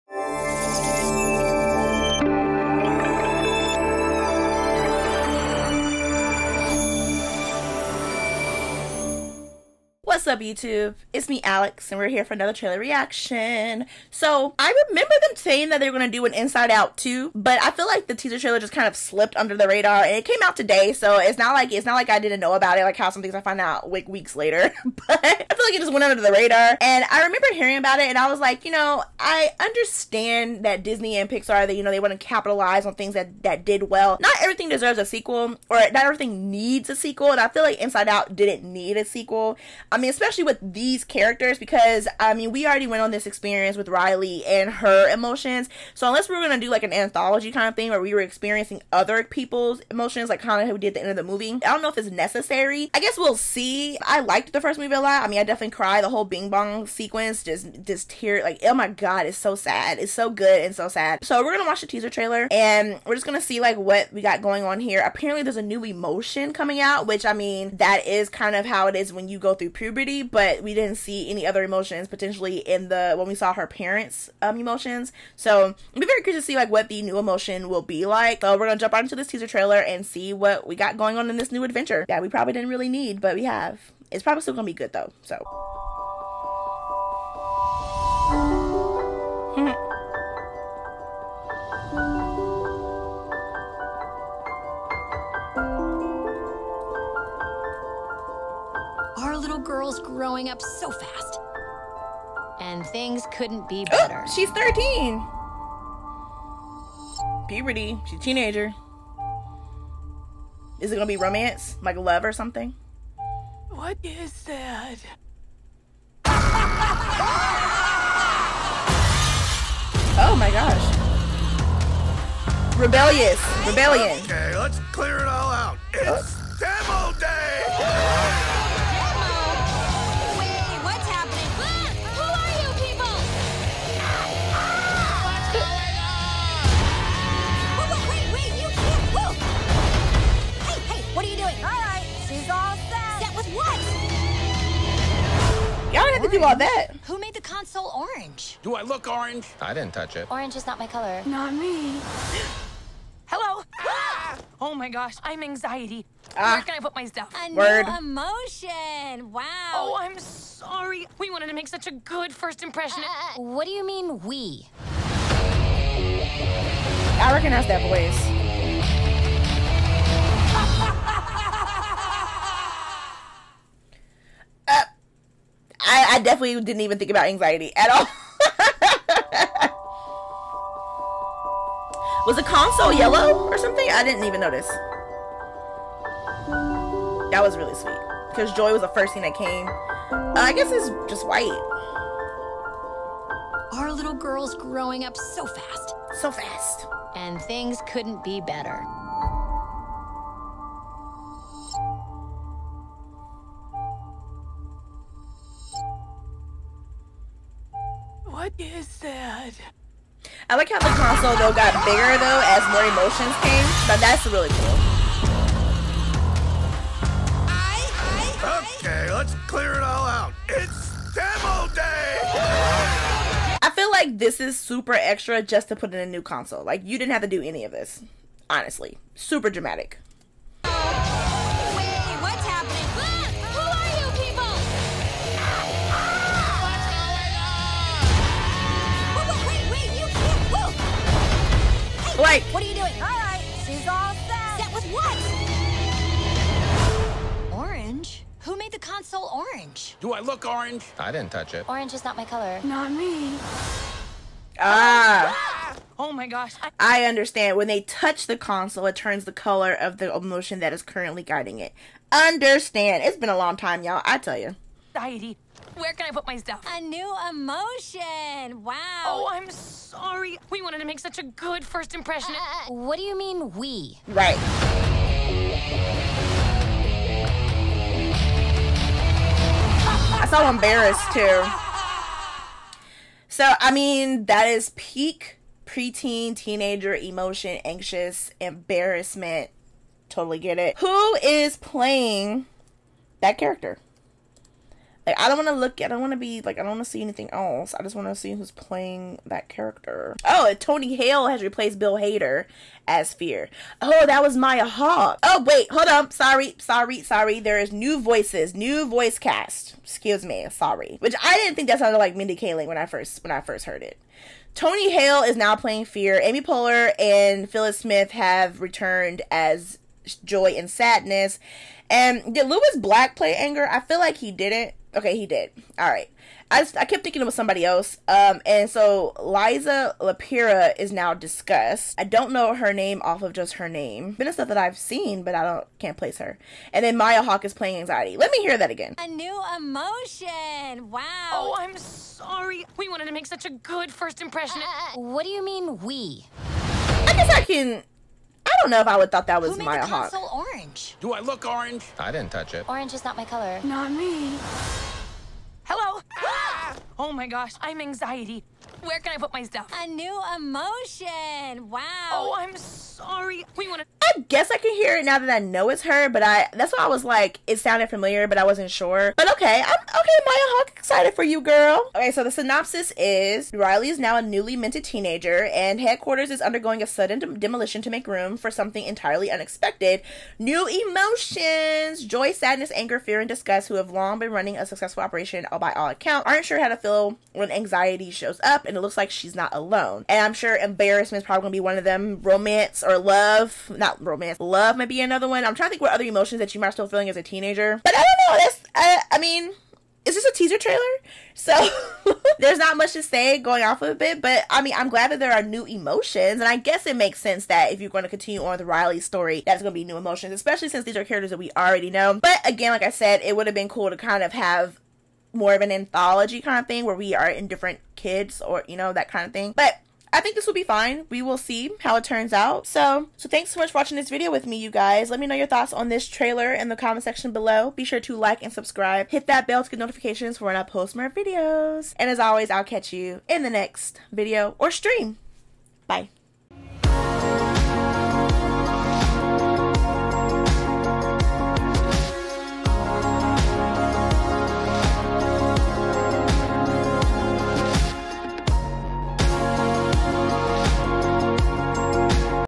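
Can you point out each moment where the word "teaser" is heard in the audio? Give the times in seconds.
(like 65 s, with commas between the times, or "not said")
18 s, 61 s, 79 s, 400 s.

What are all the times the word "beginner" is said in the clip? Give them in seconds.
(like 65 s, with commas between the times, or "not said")
not said.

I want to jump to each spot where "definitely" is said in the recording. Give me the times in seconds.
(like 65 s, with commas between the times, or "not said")
55 s, 176 s.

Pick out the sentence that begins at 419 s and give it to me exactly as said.
But I think this will be fine.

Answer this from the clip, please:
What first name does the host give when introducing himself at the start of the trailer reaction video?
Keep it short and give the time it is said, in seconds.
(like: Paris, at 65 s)
Alex, at 11 s.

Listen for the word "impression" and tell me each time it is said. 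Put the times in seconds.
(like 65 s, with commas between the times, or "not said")
162 s, 271 s, 344 s.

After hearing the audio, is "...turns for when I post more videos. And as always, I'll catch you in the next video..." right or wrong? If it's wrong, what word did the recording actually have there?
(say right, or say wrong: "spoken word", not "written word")
wrong: "notifications", not "turns".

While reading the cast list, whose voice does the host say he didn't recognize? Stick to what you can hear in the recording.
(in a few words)
Mindy Kaling.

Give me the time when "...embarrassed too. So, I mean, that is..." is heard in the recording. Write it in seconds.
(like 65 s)
280 s.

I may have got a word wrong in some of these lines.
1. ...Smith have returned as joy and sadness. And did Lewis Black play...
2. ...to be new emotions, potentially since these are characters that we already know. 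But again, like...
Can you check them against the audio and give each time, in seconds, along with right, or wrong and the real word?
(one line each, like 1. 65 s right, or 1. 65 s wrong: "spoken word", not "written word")
1. 317 s right
2. 409 s wrong: "especially", not "potentially".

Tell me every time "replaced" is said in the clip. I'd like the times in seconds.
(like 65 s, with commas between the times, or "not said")
301 s.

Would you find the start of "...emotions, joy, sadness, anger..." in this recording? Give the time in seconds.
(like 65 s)
380 s.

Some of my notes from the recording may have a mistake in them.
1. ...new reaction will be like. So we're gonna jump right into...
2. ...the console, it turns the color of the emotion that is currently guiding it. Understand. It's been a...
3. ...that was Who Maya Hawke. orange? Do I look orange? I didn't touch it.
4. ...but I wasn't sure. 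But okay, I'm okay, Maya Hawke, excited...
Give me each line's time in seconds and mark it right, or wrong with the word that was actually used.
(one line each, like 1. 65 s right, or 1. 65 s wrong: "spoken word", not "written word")
1. 77 s wrong: "emotion", not "reaction"
2. 258 s right
3. 349 s right
4. 368 s right.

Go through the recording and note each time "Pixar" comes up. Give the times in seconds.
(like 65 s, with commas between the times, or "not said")
31 s.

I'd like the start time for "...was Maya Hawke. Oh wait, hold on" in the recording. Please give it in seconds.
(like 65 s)
304 s.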